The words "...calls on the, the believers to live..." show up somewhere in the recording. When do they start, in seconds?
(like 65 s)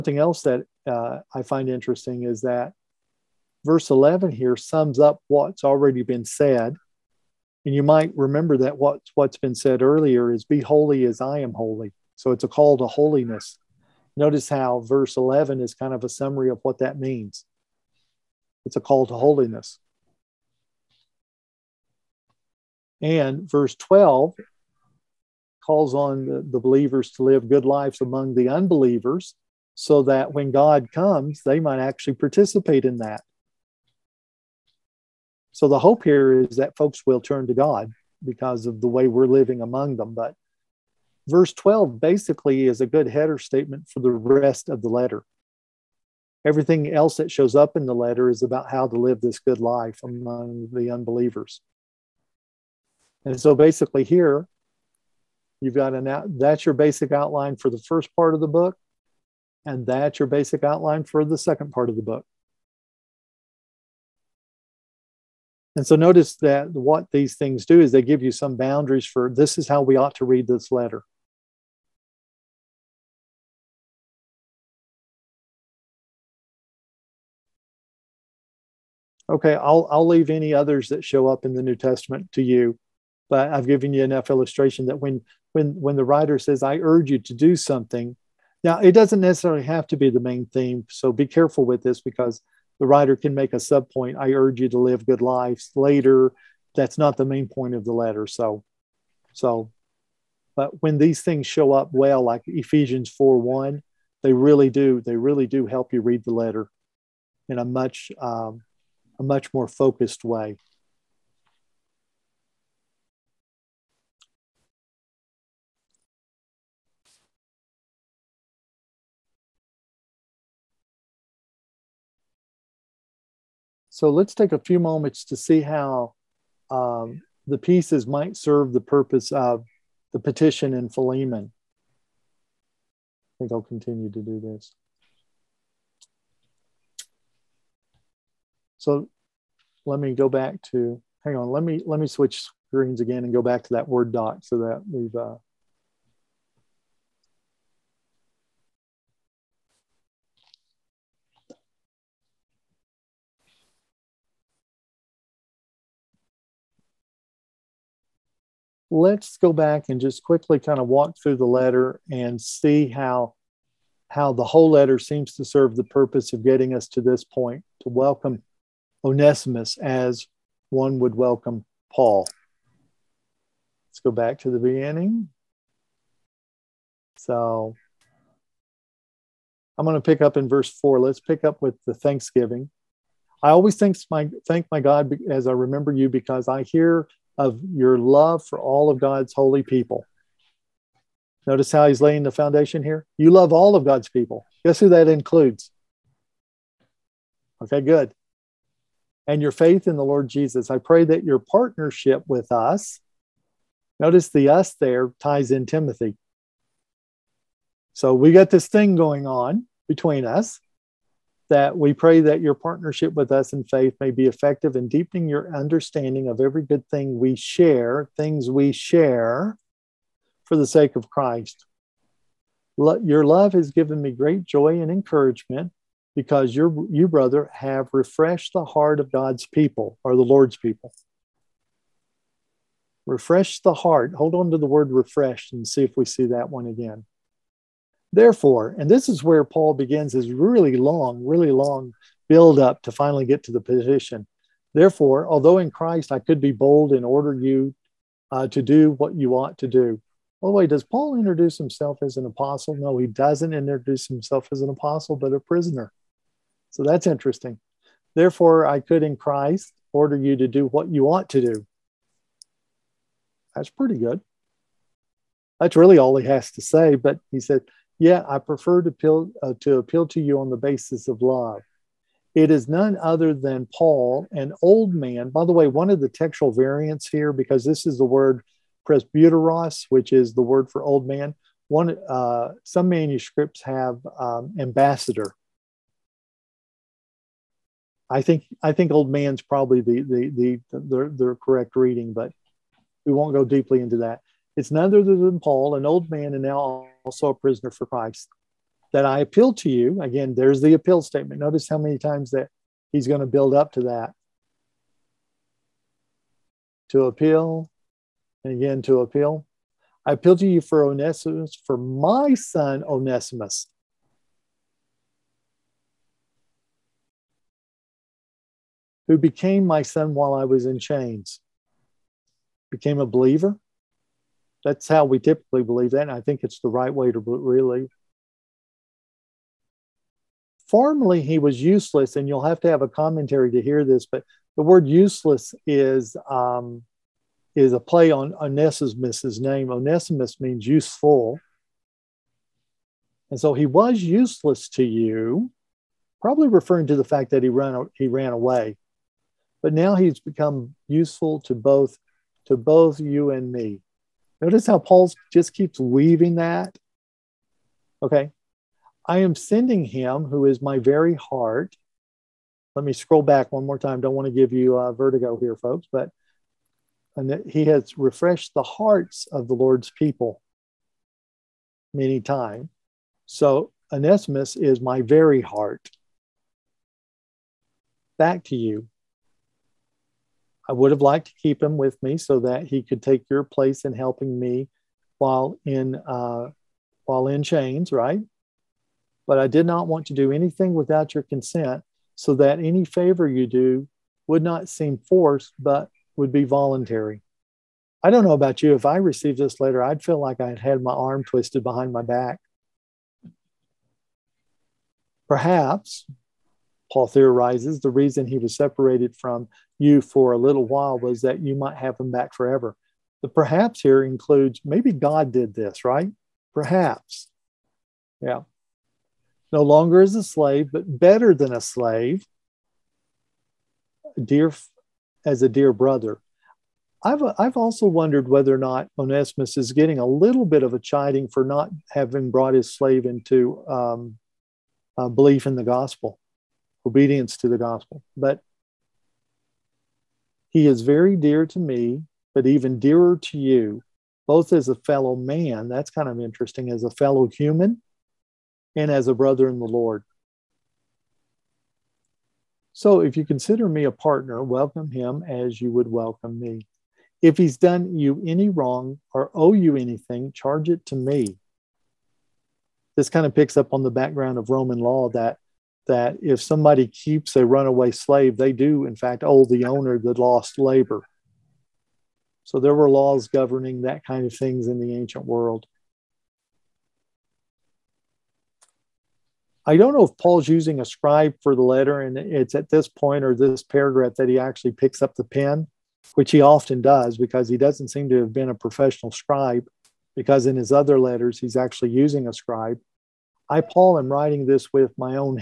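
25 s.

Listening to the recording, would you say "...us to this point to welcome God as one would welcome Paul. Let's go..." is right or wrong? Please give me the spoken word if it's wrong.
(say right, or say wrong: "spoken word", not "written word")
wrong: "Onesimus", not "God".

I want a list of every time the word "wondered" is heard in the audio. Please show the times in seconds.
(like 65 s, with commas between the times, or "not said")
427 s.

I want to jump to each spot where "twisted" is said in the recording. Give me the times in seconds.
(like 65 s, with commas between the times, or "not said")
401 s.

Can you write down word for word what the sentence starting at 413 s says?
The perhaps here includes maybe God did this, right?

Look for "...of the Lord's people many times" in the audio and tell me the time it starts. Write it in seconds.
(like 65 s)
369 s.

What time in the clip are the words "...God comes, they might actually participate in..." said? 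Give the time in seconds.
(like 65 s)
30 s.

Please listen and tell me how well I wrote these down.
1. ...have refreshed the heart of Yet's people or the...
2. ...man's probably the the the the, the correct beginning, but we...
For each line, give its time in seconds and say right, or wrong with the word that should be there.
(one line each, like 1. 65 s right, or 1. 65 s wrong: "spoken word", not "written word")
1. 227 s wrong: "God", not "Yet"
2. 289 s wrong: "reading", not "beginning".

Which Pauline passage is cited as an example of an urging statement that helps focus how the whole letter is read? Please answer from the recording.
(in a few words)
Ephesians 4:1.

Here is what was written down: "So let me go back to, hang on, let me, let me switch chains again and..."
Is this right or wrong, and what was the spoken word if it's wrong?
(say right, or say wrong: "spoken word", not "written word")
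wrong: "screens", not "chains".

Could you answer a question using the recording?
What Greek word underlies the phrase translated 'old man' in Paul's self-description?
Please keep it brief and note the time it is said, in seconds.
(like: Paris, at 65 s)
presbyteros, at 278 s.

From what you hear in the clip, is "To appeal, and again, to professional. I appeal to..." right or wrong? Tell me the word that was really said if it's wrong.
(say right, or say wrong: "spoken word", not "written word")
wrong: "appeal", not "professional".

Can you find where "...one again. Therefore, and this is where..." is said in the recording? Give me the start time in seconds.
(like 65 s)
236 s.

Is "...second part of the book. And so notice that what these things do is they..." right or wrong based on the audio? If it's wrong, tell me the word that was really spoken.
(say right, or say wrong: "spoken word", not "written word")
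right.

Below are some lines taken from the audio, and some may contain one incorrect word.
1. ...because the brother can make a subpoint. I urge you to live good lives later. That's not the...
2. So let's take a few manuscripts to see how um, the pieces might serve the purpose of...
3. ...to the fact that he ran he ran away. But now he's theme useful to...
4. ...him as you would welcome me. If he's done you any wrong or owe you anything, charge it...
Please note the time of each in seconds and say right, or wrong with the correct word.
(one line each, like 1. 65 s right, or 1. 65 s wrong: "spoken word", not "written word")
1. 91 s wrong: "writer", not "brother"
2. 123 s wrong: "moments", not "manuscripts"
3. 346 s wrong: "become", not "theme"
4. 454 s right.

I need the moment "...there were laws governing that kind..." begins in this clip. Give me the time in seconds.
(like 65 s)
472 s.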